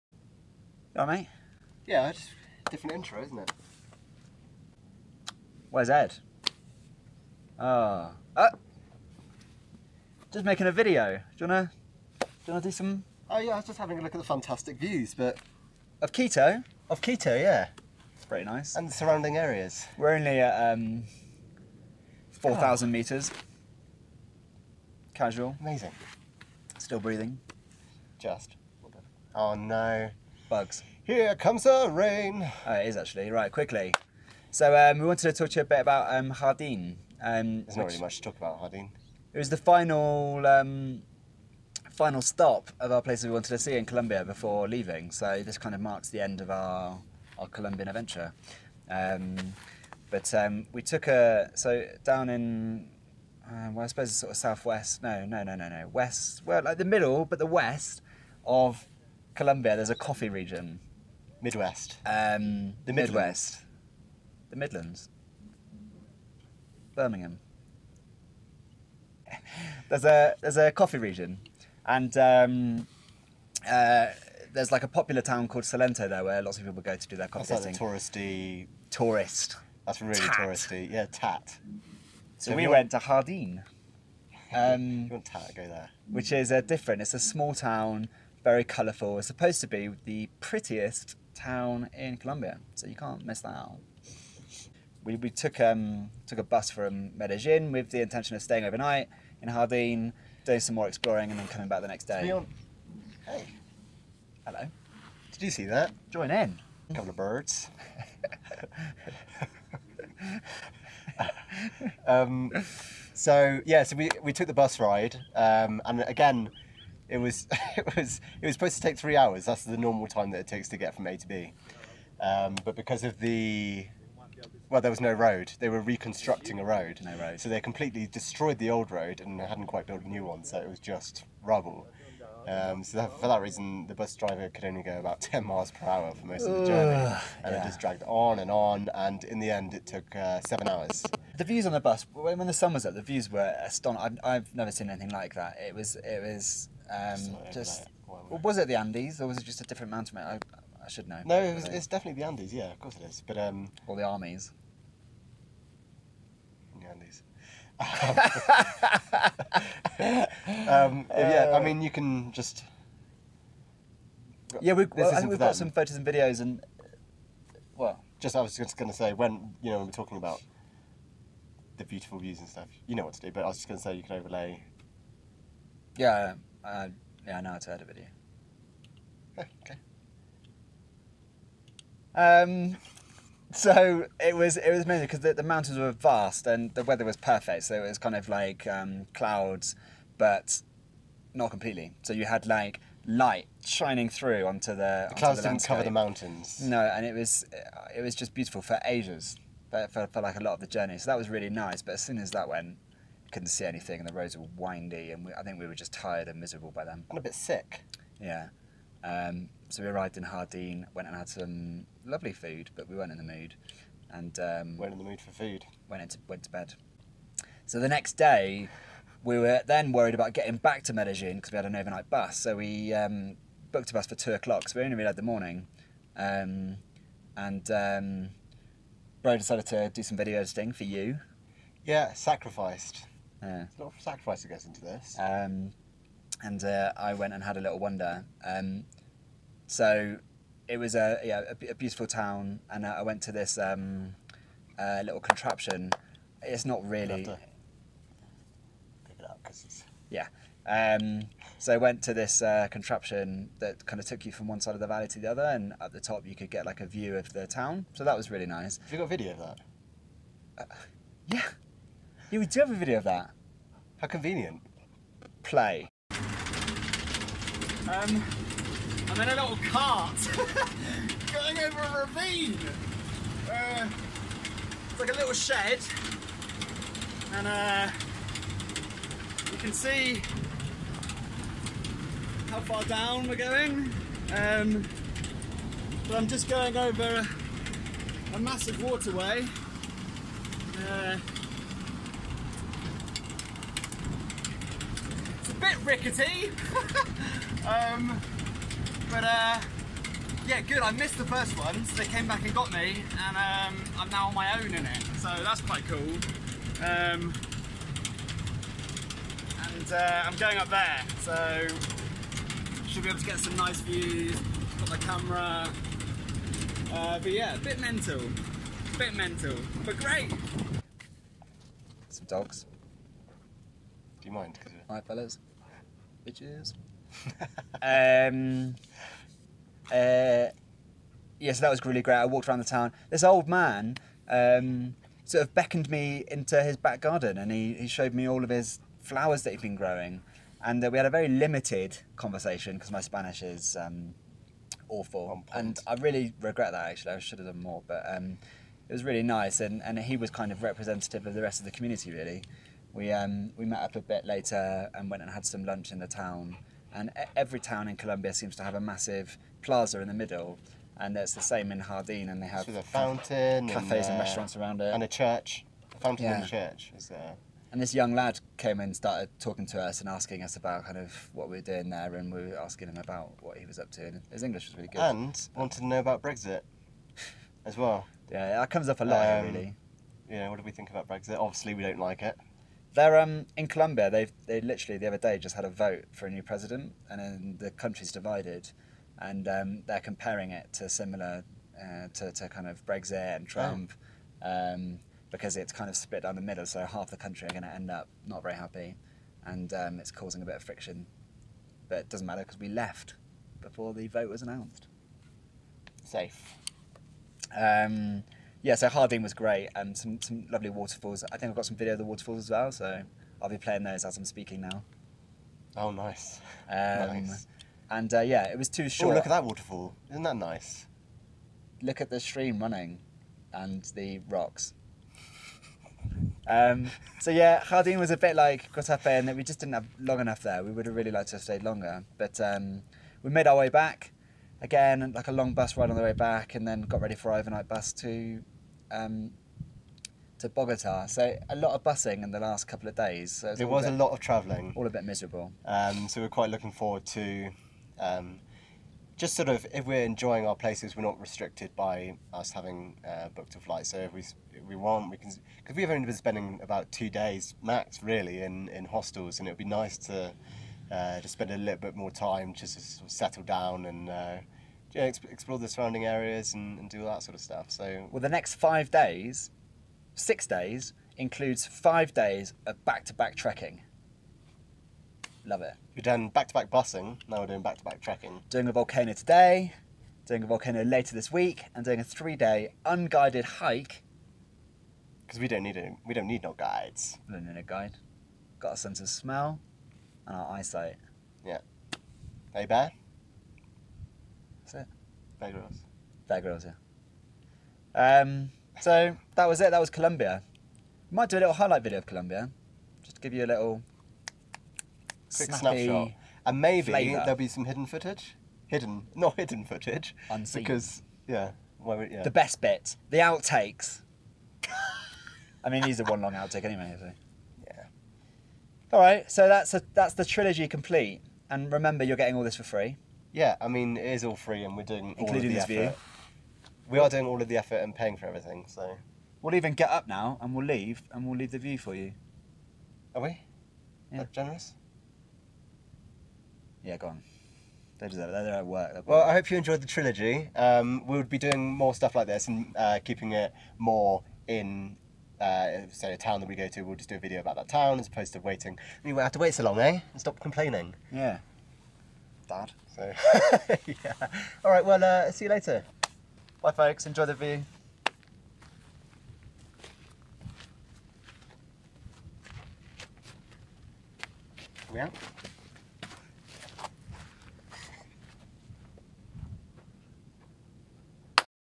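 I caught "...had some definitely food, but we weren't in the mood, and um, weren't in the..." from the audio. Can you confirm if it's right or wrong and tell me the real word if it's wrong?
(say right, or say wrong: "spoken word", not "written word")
wrong: "lovely", not "definitely".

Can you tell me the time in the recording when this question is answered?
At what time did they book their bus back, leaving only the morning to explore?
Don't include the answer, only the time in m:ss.
3:44.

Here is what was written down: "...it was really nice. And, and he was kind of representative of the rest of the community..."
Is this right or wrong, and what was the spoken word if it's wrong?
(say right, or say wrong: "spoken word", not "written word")
right.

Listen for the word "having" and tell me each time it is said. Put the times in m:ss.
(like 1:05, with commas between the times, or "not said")
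0:13, 7:32.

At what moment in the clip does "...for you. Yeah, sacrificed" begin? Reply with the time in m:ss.
3:50.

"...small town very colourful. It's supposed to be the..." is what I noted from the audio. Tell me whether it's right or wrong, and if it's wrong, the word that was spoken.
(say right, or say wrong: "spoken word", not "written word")
right.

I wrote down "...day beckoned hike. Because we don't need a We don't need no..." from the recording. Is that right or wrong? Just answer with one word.
wrong.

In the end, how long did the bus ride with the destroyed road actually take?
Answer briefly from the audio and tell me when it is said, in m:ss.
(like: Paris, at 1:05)
7 hours, at 2:20.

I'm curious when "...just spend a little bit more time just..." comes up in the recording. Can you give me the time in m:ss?
7:41.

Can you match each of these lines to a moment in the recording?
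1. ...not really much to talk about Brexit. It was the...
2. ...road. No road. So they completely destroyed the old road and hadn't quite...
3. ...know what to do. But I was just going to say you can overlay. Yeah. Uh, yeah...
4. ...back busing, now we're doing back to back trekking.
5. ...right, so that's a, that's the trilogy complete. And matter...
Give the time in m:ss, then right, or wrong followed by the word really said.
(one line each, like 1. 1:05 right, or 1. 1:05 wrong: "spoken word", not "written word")
1. 0:37 wrong: "Jardín", not "Brexit"
2. 2:06 right
3. 2:52 right
4. 7:56 right
5. 8:38 wrong: "remember", not "matter".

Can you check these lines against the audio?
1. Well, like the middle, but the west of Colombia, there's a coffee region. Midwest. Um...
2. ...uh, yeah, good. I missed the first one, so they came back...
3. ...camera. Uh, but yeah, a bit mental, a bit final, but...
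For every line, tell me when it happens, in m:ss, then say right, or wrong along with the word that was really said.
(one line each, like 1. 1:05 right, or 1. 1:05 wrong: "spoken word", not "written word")
1. 0:56 right
2. 4:59 right
3. 5:14 wrong: "mental", not "final".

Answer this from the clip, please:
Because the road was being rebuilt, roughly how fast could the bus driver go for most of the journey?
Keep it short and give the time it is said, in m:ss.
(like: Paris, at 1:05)
10 miles per hour, at 2:15.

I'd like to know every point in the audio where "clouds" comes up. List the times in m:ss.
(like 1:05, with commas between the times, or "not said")
3:09, 3:15.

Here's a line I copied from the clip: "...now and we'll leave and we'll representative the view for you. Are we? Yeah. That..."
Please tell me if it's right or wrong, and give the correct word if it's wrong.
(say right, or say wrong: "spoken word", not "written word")
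wrong: "leave", not "representative".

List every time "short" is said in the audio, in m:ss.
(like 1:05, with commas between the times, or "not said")
6:58.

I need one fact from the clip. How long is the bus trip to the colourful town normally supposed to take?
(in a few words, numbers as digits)
3 hours.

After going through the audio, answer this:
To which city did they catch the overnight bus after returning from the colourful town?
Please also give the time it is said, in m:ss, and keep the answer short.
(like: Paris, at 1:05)
Bogota, at 7:20.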